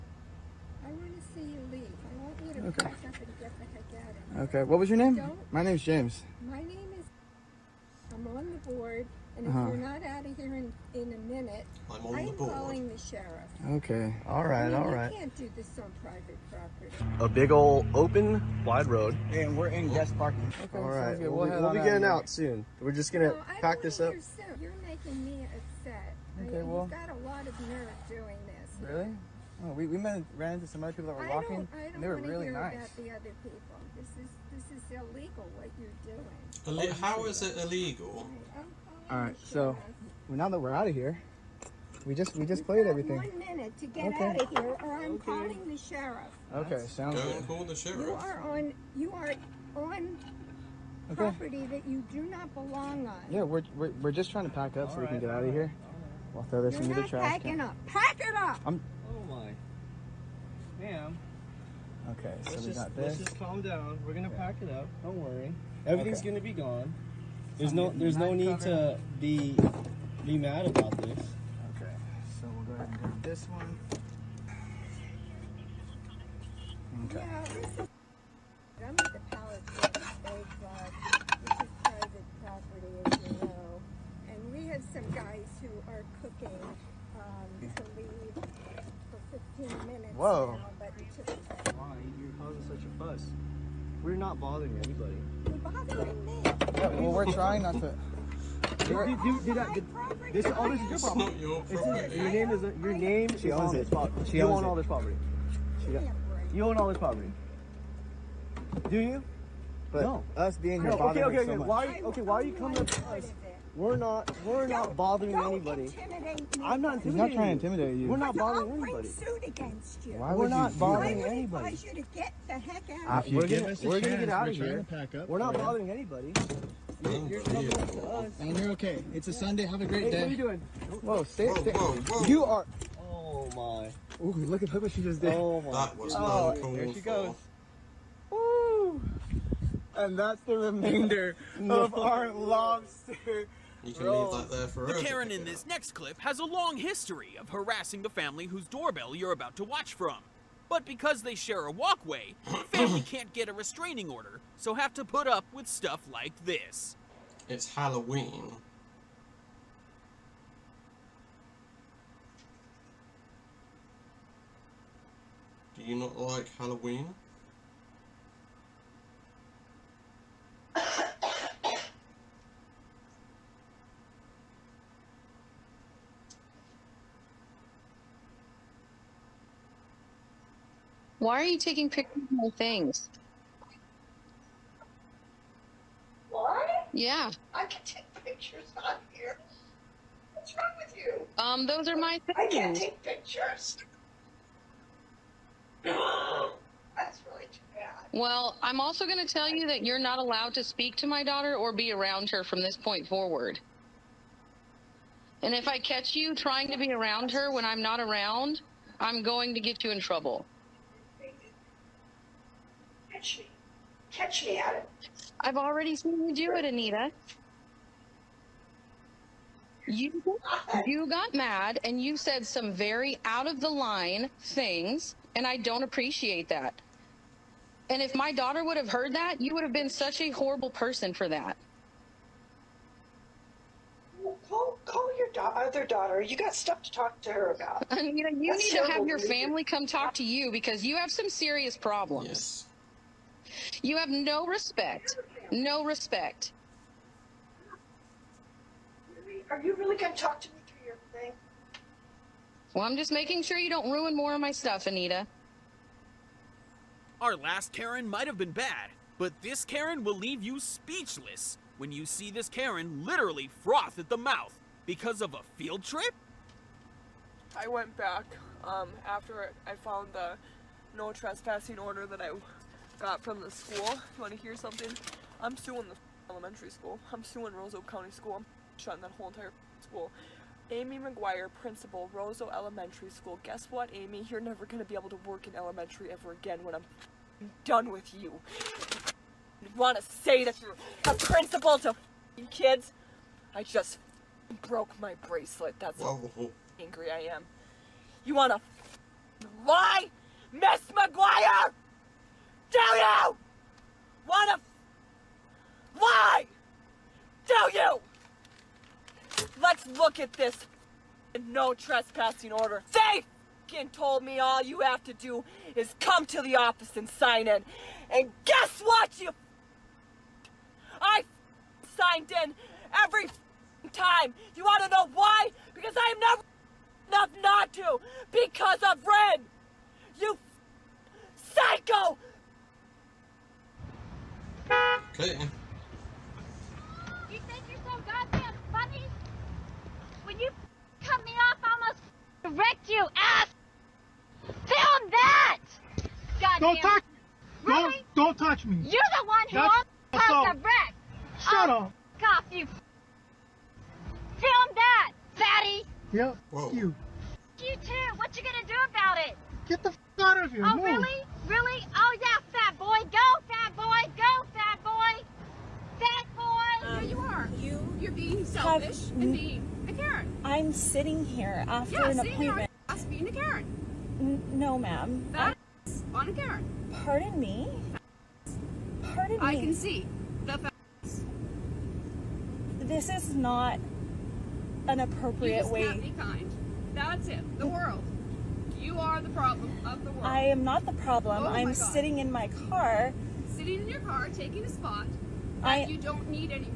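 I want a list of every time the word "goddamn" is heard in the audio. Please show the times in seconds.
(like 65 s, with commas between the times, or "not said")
338 s, 346 s.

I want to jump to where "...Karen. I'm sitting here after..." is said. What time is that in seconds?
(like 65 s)
369 s.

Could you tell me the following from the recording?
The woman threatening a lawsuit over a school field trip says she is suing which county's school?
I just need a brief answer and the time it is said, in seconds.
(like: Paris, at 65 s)
Rose Oak County, at 277 s.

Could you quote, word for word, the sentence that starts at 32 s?
About the other people, this is this is illegal what you're doing.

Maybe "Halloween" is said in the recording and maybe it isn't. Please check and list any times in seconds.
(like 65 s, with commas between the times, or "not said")
157 s, 166 s.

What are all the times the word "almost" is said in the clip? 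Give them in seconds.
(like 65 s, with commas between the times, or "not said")
341 s, 349 s.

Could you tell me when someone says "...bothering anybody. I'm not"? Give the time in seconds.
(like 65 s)
114 s.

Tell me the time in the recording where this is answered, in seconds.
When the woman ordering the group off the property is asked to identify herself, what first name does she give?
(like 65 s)
5 s.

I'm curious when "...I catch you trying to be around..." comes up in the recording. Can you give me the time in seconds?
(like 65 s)
205 s.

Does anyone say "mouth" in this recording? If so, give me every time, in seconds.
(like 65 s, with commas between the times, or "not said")
264 s.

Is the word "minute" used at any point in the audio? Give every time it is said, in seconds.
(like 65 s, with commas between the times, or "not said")
11 s, 43 s, 89 s.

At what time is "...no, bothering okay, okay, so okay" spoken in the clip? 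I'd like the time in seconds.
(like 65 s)
110 s.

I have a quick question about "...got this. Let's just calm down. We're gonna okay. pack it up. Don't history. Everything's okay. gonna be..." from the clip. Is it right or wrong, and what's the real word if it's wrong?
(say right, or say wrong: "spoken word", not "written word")
wrong: "worry", not "history".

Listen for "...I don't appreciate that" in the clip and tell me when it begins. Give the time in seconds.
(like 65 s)
225 s.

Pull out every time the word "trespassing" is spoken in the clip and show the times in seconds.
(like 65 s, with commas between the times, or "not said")
271 s, 311 s.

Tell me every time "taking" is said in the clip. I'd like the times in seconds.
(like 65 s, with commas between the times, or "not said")
181 s, 394 s.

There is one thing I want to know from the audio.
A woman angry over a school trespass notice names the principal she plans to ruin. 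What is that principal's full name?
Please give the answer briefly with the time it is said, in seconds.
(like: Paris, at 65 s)
Amy McGuire, at 280 s.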